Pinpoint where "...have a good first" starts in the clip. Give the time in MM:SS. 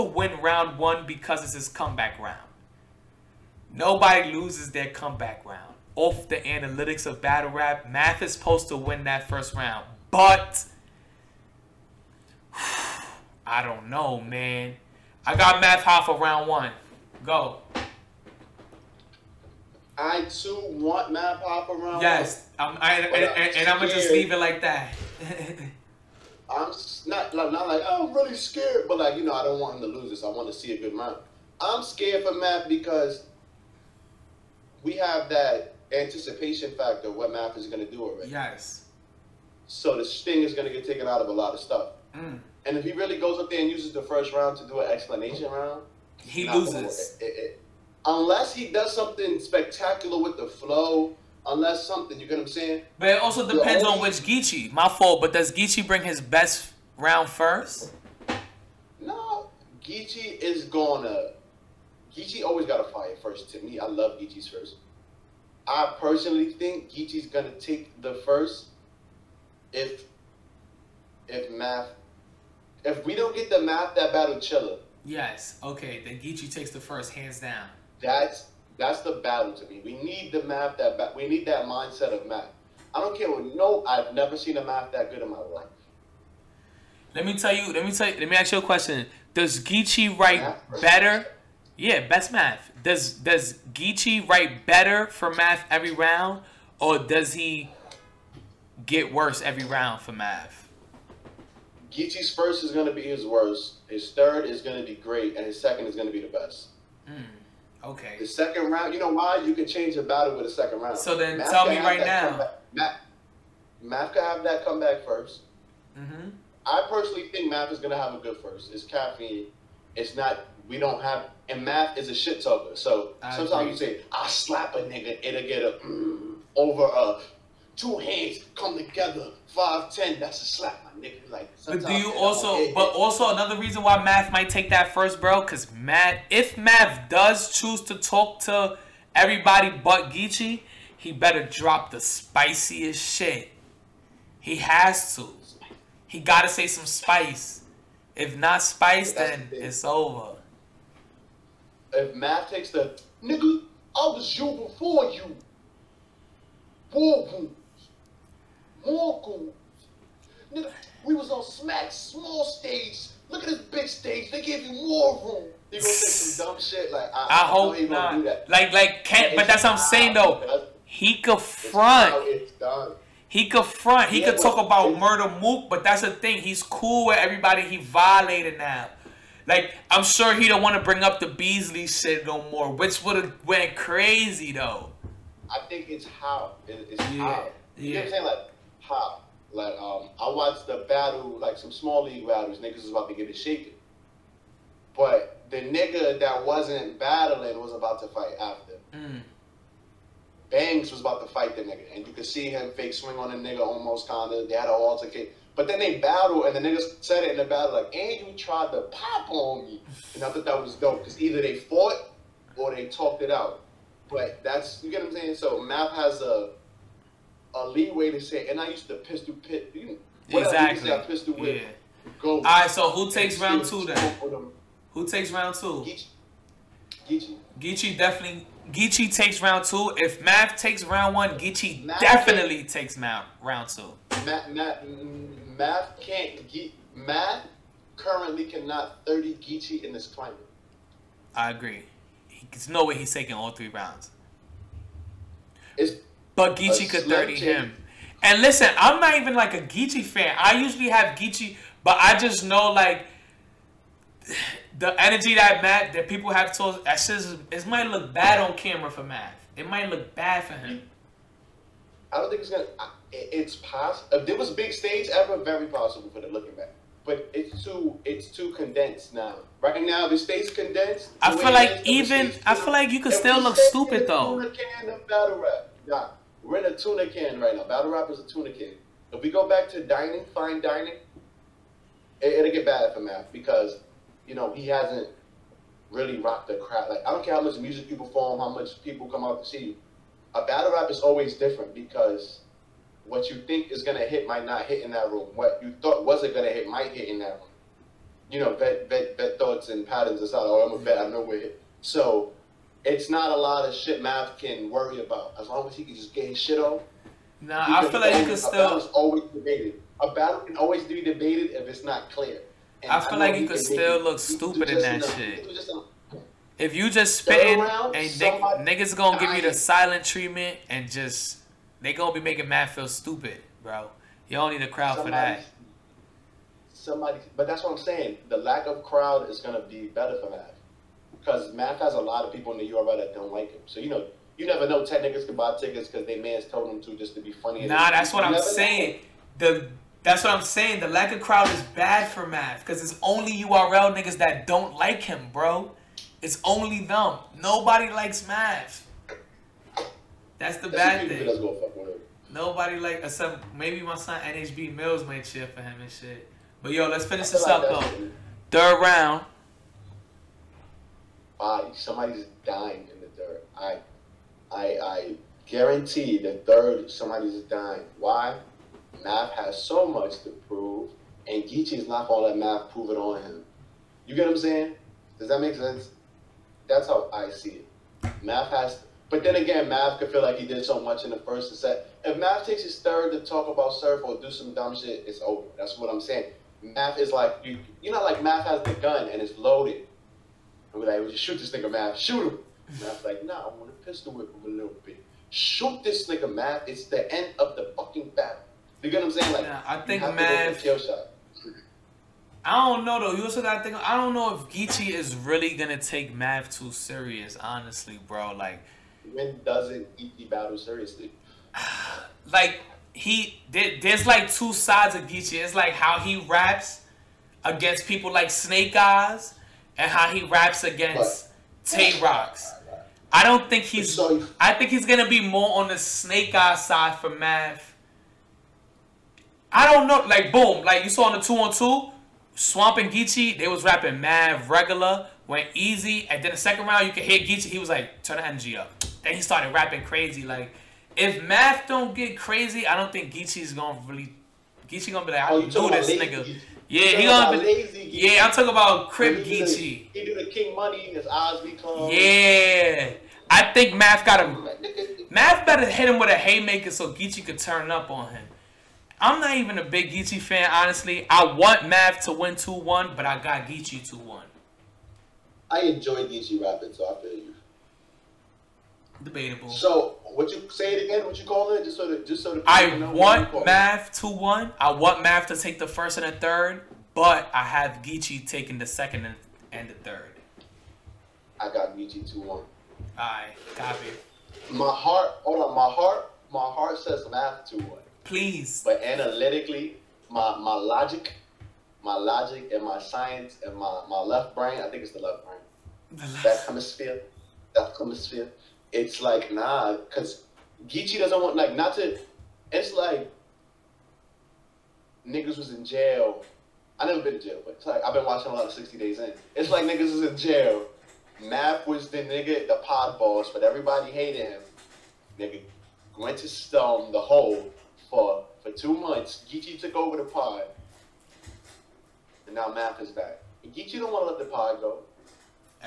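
01:57.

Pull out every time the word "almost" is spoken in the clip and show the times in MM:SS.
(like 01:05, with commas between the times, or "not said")
03:23.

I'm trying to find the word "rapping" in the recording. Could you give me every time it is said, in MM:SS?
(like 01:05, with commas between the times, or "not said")
07:13, 07:19, 07:46.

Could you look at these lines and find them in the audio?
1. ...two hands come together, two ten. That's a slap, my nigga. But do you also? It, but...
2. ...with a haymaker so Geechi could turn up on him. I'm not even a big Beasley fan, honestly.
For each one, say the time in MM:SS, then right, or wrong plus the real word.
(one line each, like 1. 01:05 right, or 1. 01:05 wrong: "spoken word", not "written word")
1. 02:07 wrong: "five", not "two"
2. 07:36 wrong: "Geechi", not "Beasley".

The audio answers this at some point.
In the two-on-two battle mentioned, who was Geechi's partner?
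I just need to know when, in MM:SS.
07:12.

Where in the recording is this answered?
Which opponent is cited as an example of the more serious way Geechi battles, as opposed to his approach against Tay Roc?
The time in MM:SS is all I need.
06:58.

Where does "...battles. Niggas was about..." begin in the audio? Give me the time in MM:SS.
03:12.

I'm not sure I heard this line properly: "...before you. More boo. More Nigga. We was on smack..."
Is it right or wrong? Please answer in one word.
right.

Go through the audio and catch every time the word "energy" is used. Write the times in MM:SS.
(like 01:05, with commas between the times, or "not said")
04:15, 07:18.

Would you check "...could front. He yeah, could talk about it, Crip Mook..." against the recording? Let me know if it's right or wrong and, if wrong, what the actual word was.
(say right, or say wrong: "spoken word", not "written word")
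wrong: "Murda", not "Crip".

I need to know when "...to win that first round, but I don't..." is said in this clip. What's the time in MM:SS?
00:08.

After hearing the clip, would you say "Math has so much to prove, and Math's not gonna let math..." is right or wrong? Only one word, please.
wrong.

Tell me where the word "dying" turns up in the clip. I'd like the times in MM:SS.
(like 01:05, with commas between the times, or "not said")
06:02, 06:07.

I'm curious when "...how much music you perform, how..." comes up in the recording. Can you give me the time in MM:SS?
04:47.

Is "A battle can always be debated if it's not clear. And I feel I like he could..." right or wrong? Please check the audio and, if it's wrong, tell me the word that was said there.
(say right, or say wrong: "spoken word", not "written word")
right.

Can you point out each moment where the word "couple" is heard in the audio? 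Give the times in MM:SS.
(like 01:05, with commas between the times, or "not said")
not said.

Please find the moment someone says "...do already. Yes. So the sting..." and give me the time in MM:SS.
00:37.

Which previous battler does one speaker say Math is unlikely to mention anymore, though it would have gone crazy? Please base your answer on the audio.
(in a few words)
Beasley.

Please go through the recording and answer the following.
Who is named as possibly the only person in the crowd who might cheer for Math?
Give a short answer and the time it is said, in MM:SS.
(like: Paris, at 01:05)
NHB Mills, at 05:54.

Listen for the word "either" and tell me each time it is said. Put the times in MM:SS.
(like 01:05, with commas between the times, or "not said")
03:31.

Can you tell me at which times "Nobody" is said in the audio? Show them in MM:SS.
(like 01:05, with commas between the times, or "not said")
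00:03, 05:47, 05:52.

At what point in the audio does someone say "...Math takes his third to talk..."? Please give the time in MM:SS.
06:22.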